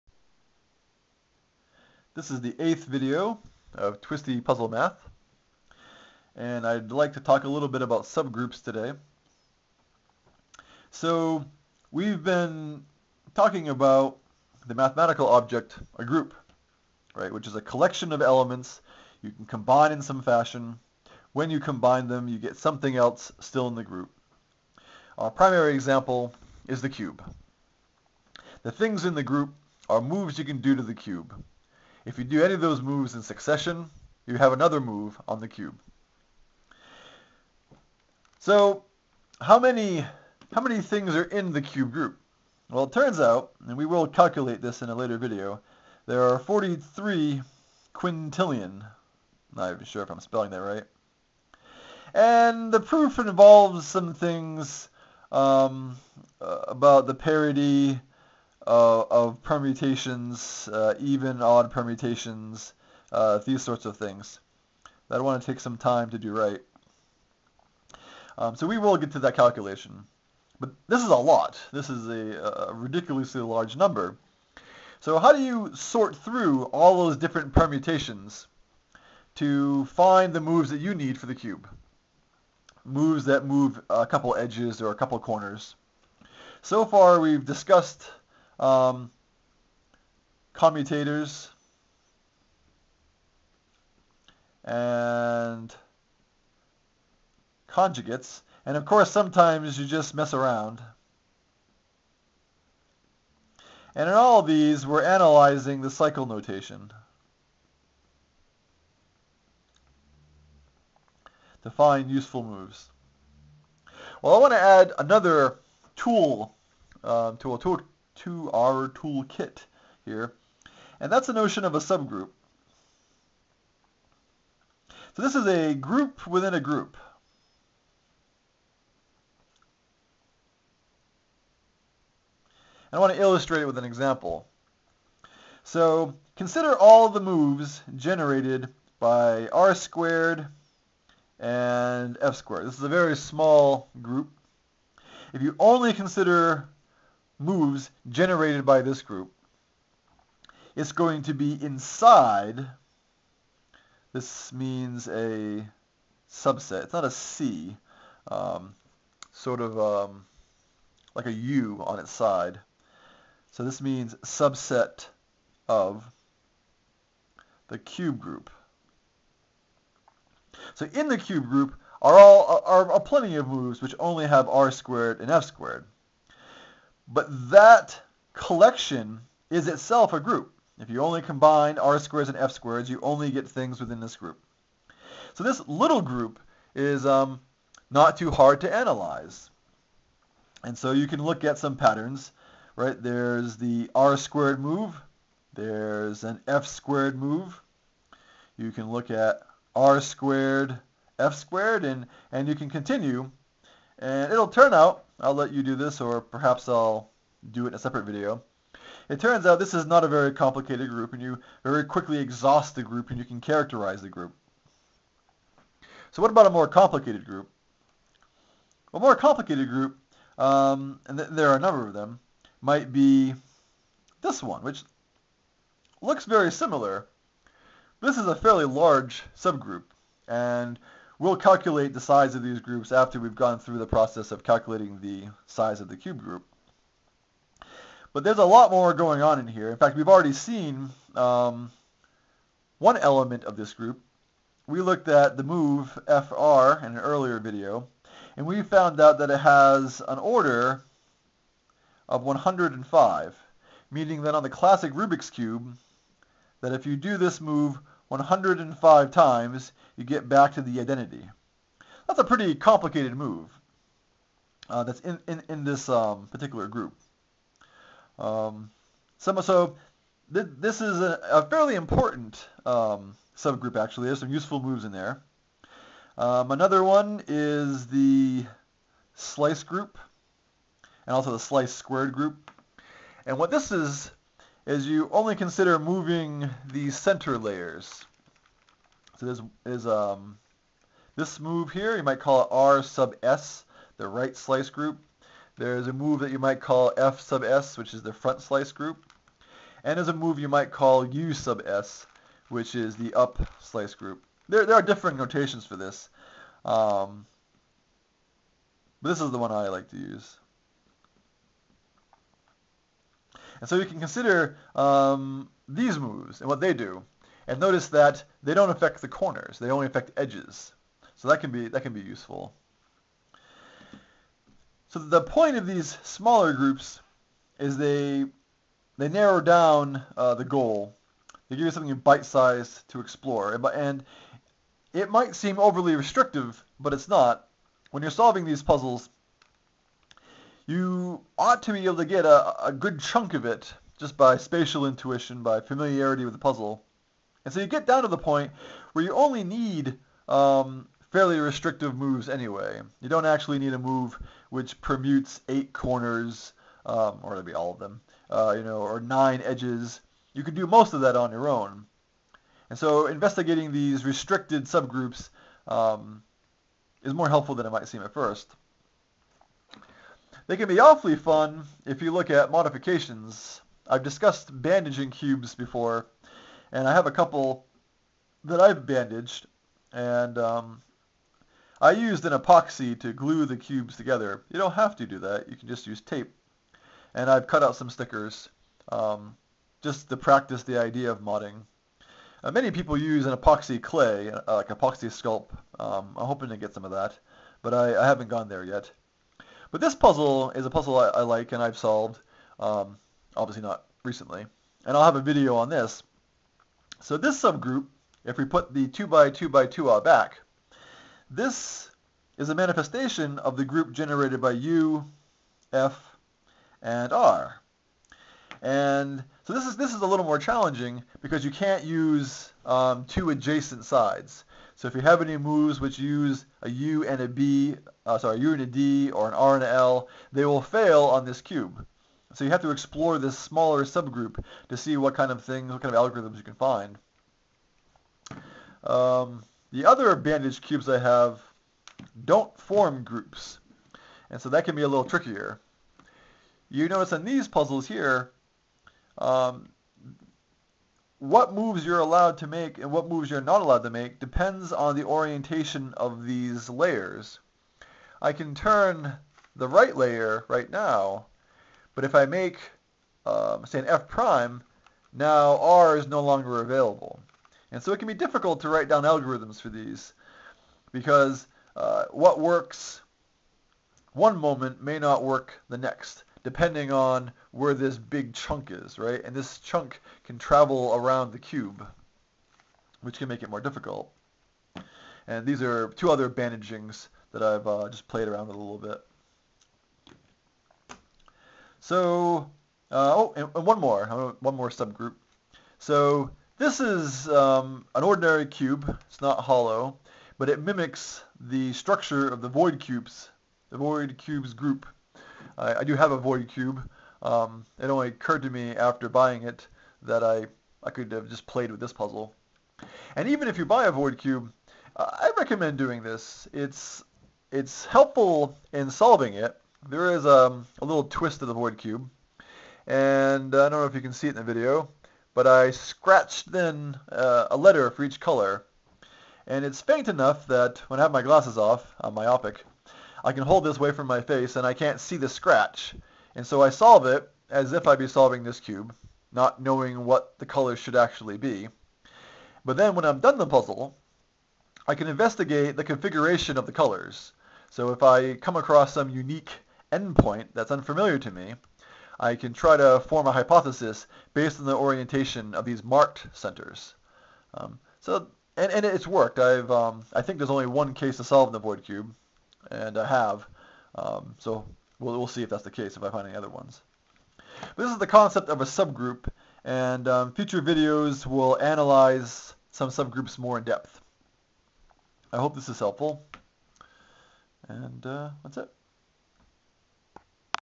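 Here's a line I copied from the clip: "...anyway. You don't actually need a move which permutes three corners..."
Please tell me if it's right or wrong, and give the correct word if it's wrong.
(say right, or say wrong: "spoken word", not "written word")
wrong: "eight", not "three".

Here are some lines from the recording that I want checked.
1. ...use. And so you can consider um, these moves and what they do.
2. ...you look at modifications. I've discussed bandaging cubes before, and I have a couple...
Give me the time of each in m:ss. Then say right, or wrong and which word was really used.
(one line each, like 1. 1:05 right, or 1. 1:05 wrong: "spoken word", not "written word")
1. 5:09 right
2. 6:12 right.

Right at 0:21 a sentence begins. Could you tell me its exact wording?
When you combine them, you get something else still in the group.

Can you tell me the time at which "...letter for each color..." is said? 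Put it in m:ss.
8:47.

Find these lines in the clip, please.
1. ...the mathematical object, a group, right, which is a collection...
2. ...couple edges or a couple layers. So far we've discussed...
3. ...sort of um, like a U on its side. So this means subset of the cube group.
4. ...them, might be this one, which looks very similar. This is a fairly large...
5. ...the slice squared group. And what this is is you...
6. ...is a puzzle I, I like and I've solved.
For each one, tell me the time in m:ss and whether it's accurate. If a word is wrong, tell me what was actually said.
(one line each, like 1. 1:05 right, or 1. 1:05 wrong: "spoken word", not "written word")
1. 0:14 right
2. 1:24 wrong: "corners", not "layers"
3. 2:39 right
4. 3:41 right
5. 4:41 right
6. 6:40 right.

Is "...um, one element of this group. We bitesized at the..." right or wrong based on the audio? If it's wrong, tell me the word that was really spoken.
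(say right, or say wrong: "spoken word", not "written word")
wrong: "looked", not "bitesized".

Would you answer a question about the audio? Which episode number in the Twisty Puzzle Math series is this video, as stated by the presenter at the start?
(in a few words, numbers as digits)
8th.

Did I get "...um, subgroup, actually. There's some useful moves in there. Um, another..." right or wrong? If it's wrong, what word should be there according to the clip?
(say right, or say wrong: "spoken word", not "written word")
right.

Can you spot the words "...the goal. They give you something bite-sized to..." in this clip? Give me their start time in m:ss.
5:30.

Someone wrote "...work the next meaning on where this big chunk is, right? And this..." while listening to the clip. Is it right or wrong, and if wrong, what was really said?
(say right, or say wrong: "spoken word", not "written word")
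wrong: "depending", not "meaning".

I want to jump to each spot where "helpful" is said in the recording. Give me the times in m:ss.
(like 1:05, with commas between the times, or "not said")
6:07, 8:37, 9:35.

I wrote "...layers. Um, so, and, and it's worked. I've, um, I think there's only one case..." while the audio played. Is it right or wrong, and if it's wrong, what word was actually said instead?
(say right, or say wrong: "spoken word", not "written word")
wrong: "centers", not "layers".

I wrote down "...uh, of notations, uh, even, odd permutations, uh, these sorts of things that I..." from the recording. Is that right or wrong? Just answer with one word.
wrong.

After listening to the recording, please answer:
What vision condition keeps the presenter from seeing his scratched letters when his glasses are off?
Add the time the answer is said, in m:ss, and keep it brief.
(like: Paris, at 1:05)
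myopic, at 8:52.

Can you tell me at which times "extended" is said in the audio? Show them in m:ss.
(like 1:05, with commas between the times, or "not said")
not said.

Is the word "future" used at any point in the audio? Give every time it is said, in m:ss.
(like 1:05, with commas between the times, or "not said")
9:30.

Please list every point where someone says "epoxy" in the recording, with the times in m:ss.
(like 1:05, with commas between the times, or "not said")
6:22, 6:33.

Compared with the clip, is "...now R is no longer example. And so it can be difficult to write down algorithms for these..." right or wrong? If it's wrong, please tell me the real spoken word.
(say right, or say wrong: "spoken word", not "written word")
wrong: "available", not "example".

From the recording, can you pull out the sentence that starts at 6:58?
And so this is, this is a little more challenging because you can't use um, two adjacent sides.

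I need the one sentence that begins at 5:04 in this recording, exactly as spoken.
There, there are different notations for this.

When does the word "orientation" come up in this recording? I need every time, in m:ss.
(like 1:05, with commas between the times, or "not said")
7:35, 9:14.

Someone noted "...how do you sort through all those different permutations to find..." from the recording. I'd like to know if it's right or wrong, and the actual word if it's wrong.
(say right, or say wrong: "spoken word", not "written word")
right.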